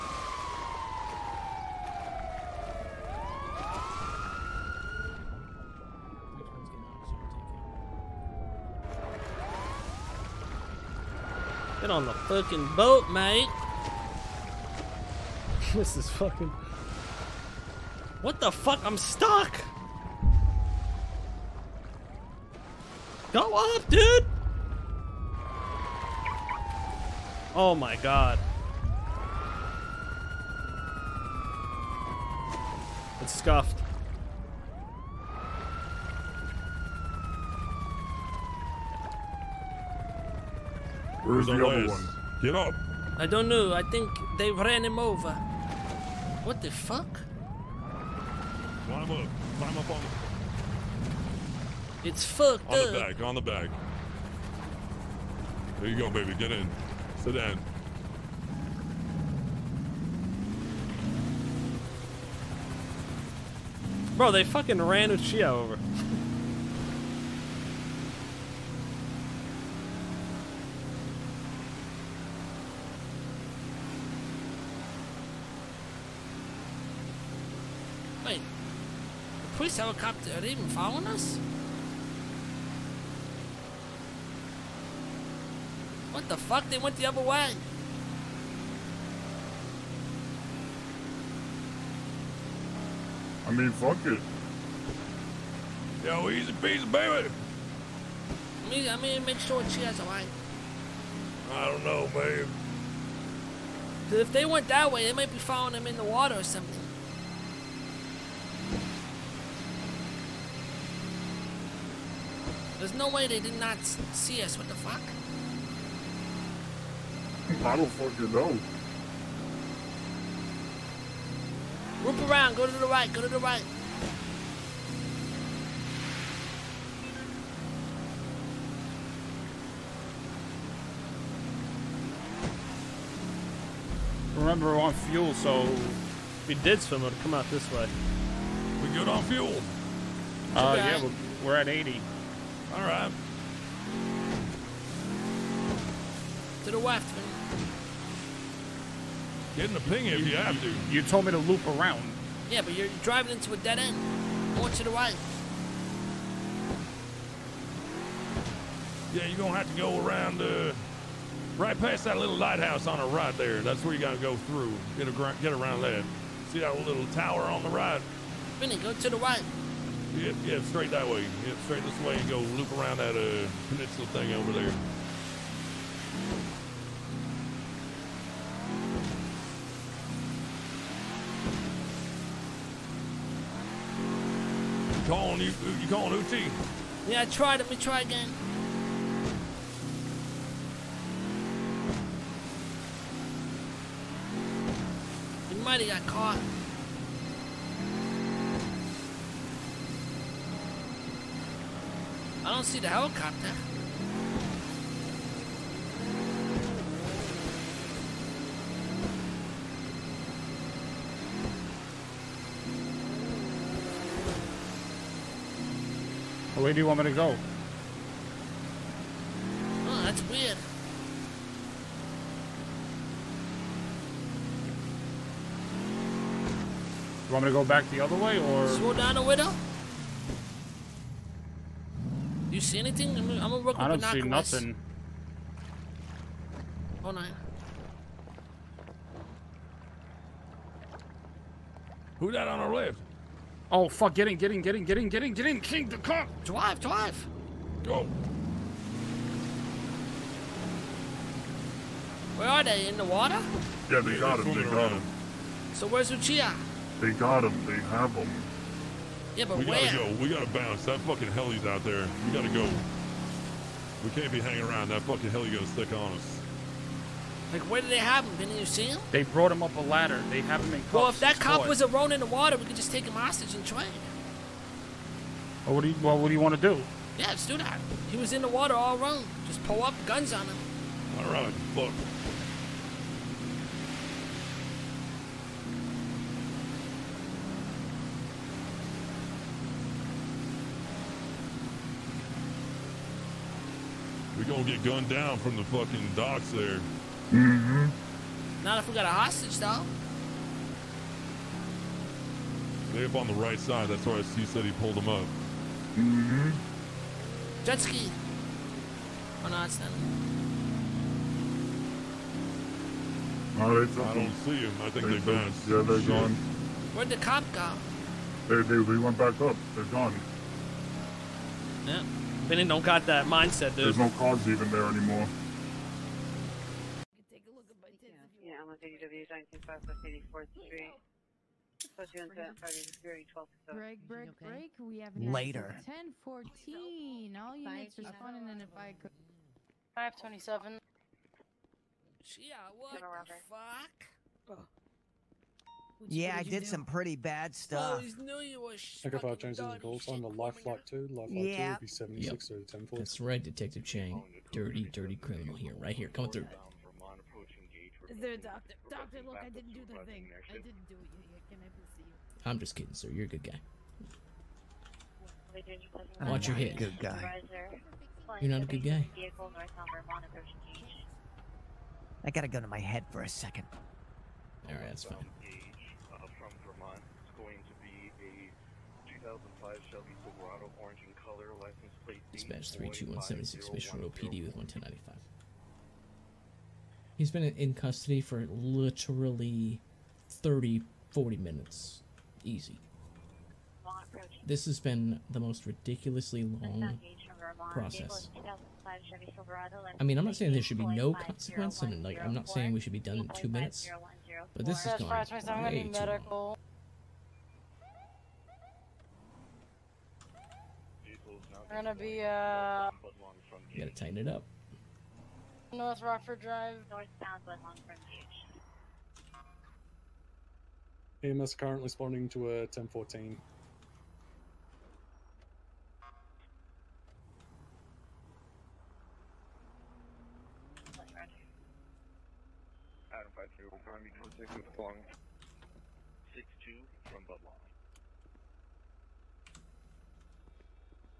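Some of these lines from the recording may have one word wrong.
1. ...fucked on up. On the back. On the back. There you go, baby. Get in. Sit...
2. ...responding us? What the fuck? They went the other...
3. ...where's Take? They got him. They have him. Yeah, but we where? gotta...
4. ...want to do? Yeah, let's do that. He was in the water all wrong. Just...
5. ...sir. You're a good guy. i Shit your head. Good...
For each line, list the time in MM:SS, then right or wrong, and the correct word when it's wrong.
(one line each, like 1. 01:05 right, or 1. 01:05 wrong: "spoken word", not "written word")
1. 00:52 right
2. 01:20 wrong: "following", not "responding"
3. 04:15 wrong: "Uchiha", not "Take"
4. 04:36 right
5. 06:02 wrong: "Watch", not "Shit".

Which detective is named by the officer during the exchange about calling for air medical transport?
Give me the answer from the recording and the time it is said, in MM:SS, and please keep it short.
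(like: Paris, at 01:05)
Detective Chang, at 05:53.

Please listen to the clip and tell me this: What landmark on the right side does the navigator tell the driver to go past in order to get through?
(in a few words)
little lighthouse.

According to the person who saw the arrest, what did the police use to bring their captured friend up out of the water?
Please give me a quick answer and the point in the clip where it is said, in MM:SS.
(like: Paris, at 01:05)
a ladder, at 04:29.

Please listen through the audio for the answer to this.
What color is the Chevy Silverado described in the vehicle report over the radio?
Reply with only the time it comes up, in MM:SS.
06:20.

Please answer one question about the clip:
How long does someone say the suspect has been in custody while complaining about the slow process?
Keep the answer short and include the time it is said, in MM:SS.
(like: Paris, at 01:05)
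30 to 40 minutes, at 06:30.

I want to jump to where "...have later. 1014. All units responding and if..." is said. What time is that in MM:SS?
05:34.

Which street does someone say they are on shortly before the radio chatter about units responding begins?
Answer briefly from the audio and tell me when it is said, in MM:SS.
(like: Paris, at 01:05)
DW Street, at 05:28.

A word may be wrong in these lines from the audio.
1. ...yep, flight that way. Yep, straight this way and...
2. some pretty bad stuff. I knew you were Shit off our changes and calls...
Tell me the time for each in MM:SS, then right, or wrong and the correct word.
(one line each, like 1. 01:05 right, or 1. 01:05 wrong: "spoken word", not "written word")
1. 02:50 wrong: "straight", not "flight"
2. 05:46 wrong: "Take", not "Shit".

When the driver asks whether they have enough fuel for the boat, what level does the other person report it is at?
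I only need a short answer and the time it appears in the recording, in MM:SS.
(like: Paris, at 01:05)
80, at 02:21.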